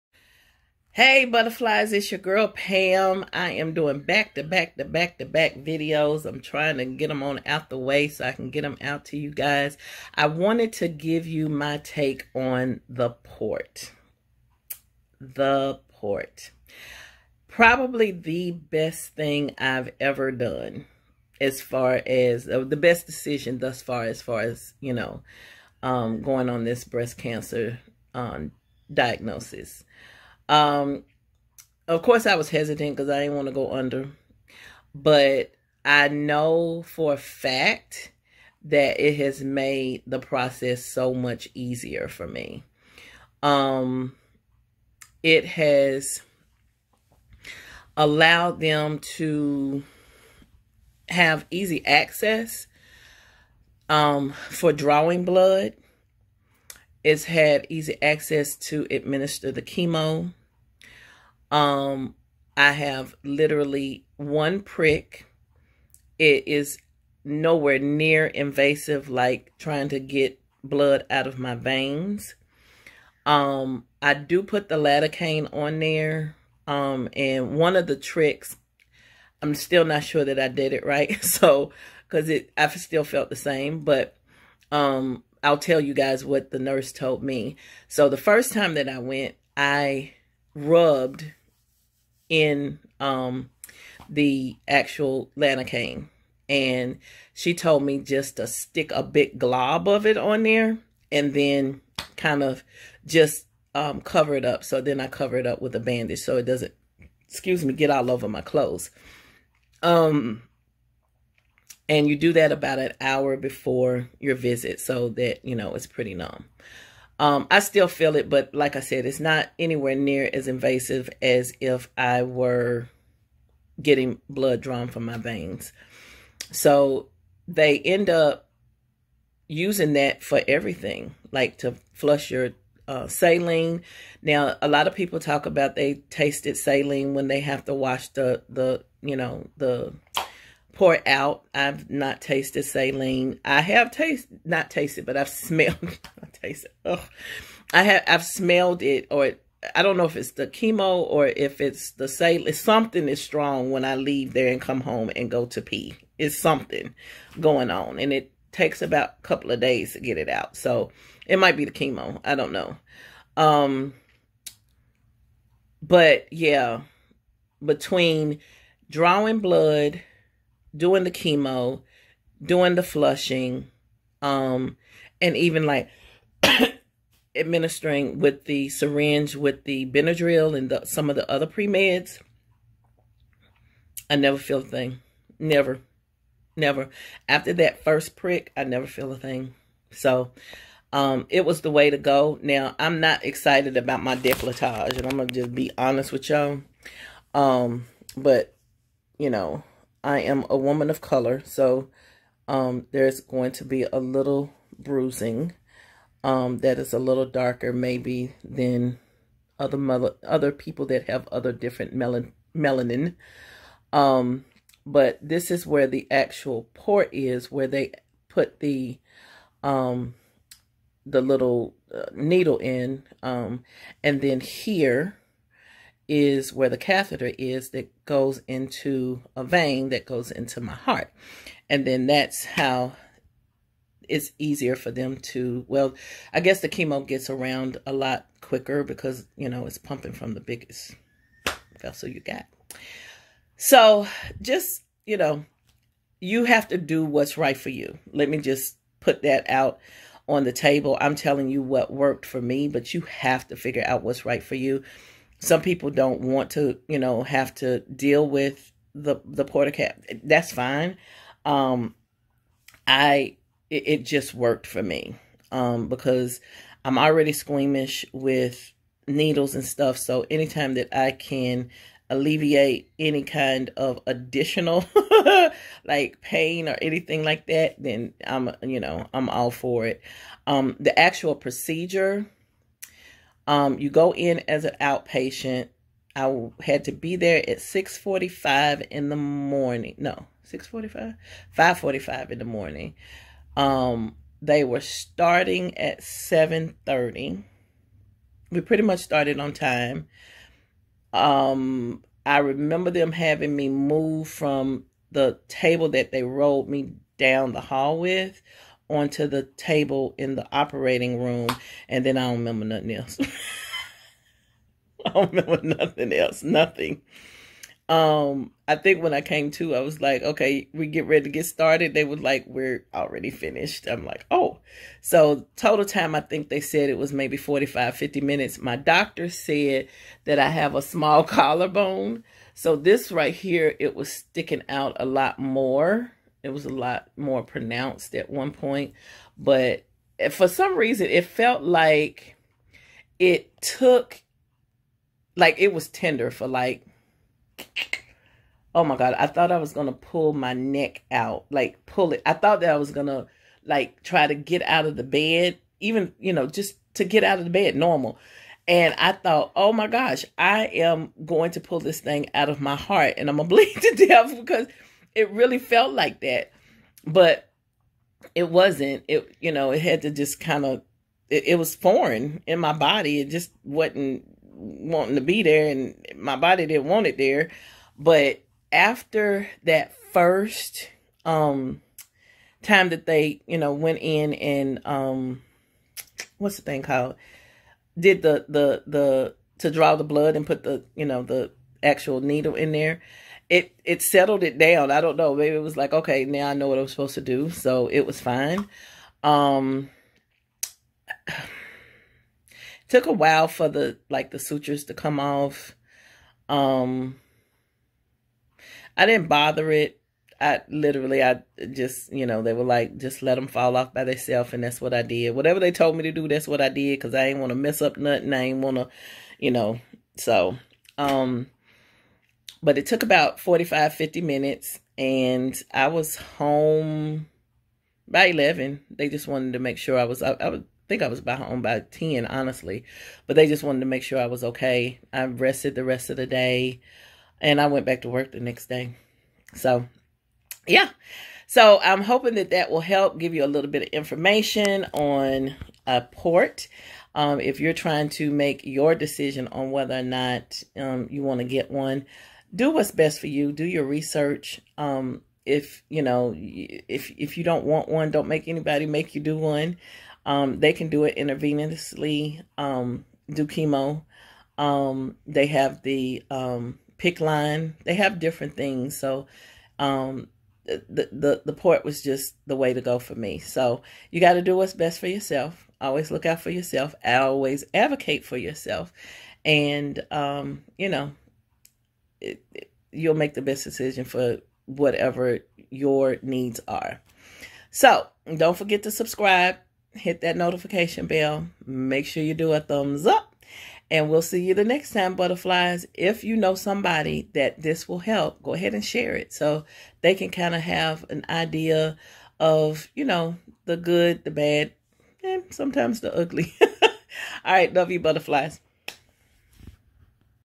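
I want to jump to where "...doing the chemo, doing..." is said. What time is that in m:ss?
2:50.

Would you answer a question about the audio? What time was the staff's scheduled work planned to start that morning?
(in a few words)
7:30.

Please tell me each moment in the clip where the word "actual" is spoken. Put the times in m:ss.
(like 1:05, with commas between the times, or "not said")
1:34, 3:36, 4:40, 6:31.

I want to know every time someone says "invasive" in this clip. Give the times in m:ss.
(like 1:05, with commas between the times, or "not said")
1:08, 2:00.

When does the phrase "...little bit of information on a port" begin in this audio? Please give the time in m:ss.
7:23.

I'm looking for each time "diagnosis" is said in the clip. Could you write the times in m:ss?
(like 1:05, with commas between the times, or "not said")
0:28.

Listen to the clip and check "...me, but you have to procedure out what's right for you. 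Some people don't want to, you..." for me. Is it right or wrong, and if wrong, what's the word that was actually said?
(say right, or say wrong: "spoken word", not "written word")
wrong: "figure", not "procedure".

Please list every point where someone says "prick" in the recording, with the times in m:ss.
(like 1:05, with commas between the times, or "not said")
1:04, 3:08.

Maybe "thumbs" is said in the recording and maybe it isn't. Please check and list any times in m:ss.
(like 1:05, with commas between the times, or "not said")
8:12.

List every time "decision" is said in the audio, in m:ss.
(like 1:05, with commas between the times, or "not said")
0:23, 7:28, 8:03.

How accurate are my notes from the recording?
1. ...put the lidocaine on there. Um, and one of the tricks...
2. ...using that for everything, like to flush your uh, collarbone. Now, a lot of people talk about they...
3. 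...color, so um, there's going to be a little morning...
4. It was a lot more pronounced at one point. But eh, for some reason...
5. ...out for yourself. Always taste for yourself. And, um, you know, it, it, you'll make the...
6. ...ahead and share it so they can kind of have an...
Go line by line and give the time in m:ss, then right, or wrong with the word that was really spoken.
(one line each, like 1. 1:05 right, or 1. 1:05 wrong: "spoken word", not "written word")
1. 1:14 right
2. 2:09 wrong: "saline", not "collarbone"
3. 3:20 wrong: "bruising", not "morning"
4. 5:36 right
5. 7:56 wrong: "advocate", not "taste"
6. 8:18 right.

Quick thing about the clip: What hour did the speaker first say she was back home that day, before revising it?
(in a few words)
11.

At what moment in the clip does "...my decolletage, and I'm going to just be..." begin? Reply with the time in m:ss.
3:14.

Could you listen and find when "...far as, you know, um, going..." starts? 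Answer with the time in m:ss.
0:24.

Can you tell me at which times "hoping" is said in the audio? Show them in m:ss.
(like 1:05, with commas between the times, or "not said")
7:22.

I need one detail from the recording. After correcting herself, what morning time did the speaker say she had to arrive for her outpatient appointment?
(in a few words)
5:45.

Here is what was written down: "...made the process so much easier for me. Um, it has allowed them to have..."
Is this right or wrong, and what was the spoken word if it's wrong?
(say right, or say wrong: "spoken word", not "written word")
right.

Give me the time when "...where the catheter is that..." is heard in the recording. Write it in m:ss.
3:46.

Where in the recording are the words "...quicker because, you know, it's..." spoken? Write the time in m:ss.
3:58.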